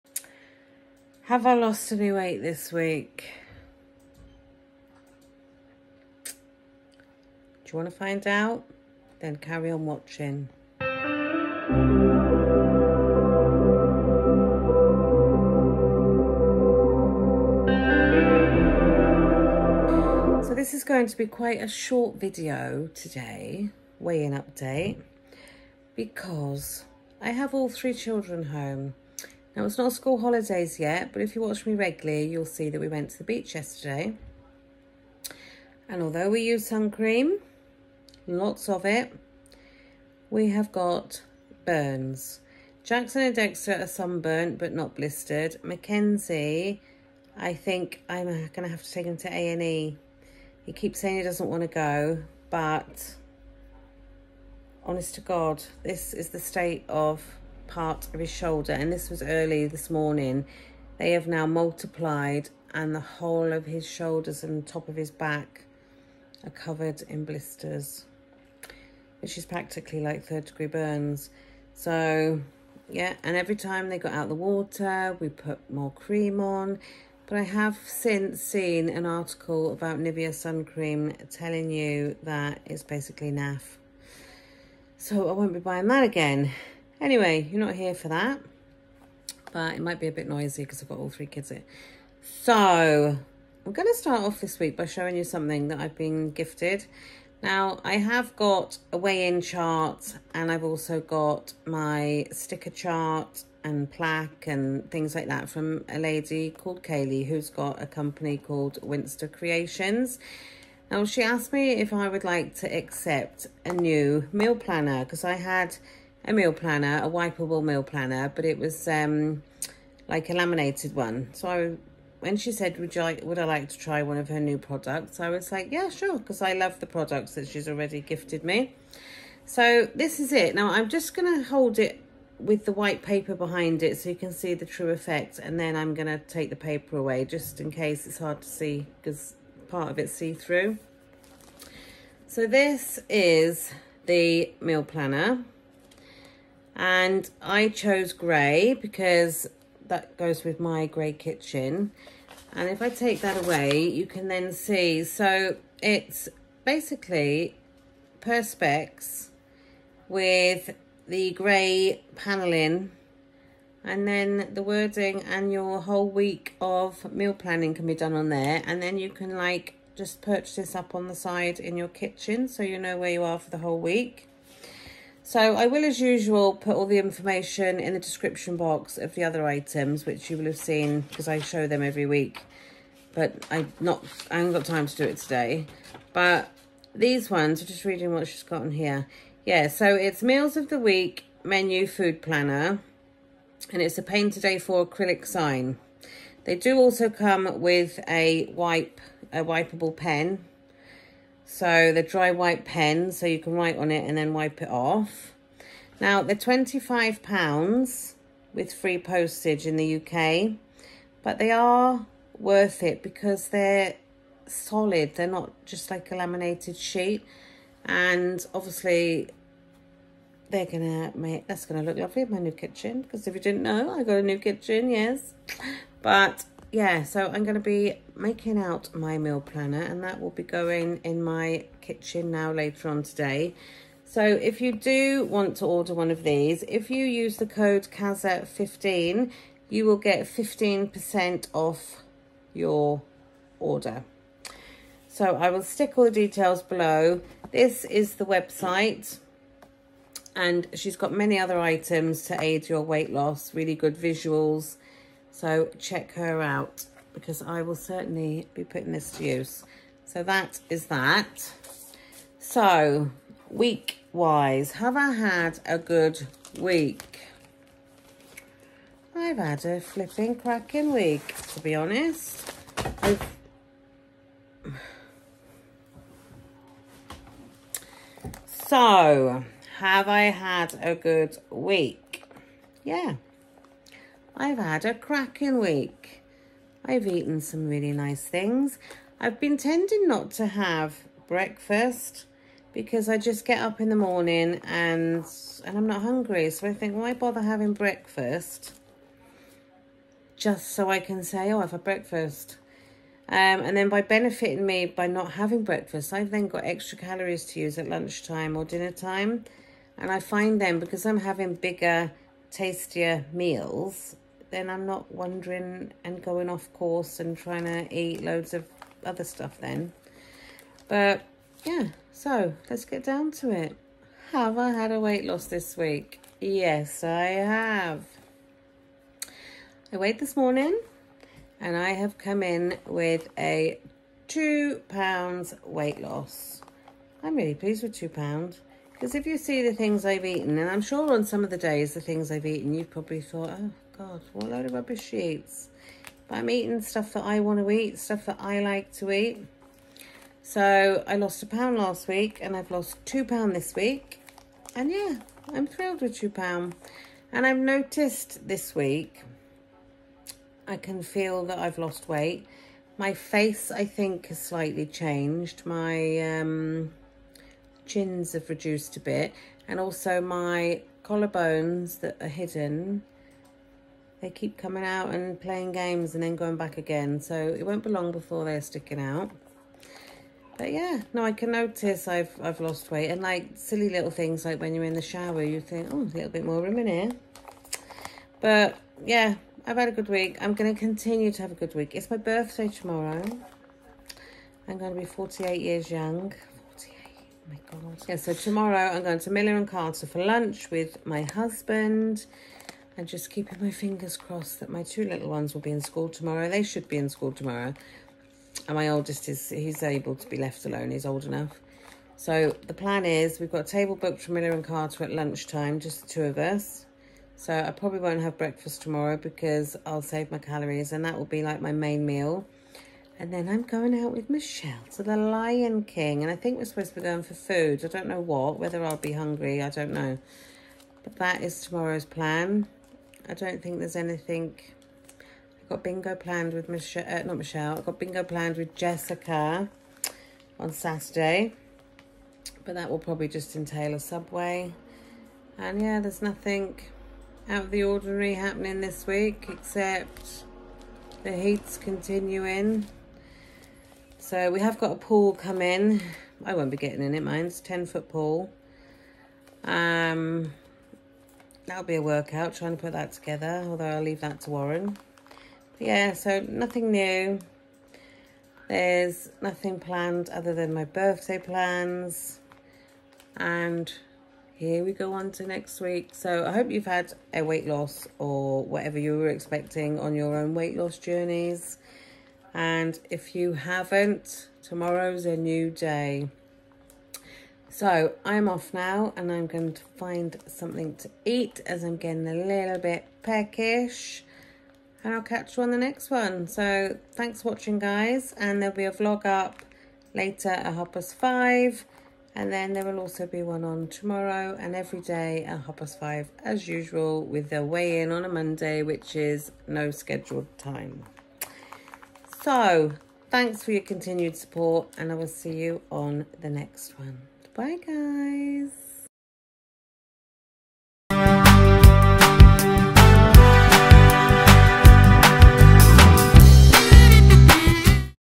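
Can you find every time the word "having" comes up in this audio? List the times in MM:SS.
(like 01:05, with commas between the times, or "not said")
04:57, 05:05, 05:11.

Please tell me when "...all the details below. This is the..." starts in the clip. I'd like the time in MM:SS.
04:05.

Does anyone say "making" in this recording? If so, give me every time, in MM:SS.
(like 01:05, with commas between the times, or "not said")
03:48.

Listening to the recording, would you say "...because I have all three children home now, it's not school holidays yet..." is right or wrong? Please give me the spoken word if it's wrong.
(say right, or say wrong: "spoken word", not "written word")
right.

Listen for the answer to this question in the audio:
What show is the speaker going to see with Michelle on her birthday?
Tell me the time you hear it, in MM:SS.
07:05.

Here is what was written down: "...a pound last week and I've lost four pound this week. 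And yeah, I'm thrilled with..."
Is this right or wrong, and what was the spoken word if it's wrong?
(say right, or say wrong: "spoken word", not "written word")
wrong: "two", not "four".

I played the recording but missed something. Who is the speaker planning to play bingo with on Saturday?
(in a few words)
Jessica.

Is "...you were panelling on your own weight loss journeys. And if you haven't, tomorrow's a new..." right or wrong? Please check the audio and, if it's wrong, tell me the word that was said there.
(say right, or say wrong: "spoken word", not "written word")
wrong: "expecting", not "panelling".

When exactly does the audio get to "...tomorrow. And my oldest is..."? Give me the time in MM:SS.
06:47.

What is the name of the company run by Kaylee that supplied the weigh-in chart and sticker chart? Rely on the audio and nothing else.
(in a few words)
Winster Creations.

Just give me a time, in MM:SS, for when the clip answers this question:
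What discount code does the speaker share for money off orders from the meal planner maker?
03:57.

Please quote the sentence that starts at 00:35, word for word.
And although we use sun cream, lots of it, we have got burns.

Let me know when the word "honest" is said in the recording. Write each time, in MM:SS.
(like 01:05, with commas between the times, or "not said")
00:54, 04:31.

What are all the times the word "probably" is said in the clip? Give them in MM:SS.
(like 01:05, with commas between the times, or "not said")
05:42, 06:57, 07:22.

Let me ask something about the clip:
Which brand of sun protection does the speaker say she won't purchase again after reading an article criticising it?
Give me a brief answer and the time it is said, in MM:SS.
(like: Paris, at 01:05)
Nivea, at 01:19.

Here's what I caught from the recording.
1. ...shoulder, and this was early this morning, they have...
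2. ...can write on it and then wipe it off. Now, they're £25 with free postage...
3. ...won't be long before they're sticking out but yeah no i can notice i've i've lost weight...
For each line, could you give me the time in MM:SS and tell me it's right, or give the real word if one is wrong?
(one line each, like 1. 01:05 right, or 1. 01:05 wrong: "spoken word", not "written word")
1. 00:58 right
2. 03:23 right
3. 06:17 right.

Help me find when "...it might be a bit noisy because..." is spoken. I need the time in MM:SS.
01:29.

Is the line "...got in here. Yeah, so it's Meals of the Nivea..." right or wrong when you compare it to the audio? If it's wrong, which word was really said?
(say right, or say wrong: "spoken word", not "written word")
wrong: "Week", not "Nivea".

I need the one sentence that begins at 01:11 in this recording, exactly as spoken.
So yeah, and every time they got out the water, we put more cream on.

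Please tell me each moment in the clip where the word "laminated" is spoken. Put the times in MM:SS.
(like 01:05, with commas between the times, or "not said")
02:00, 03:36.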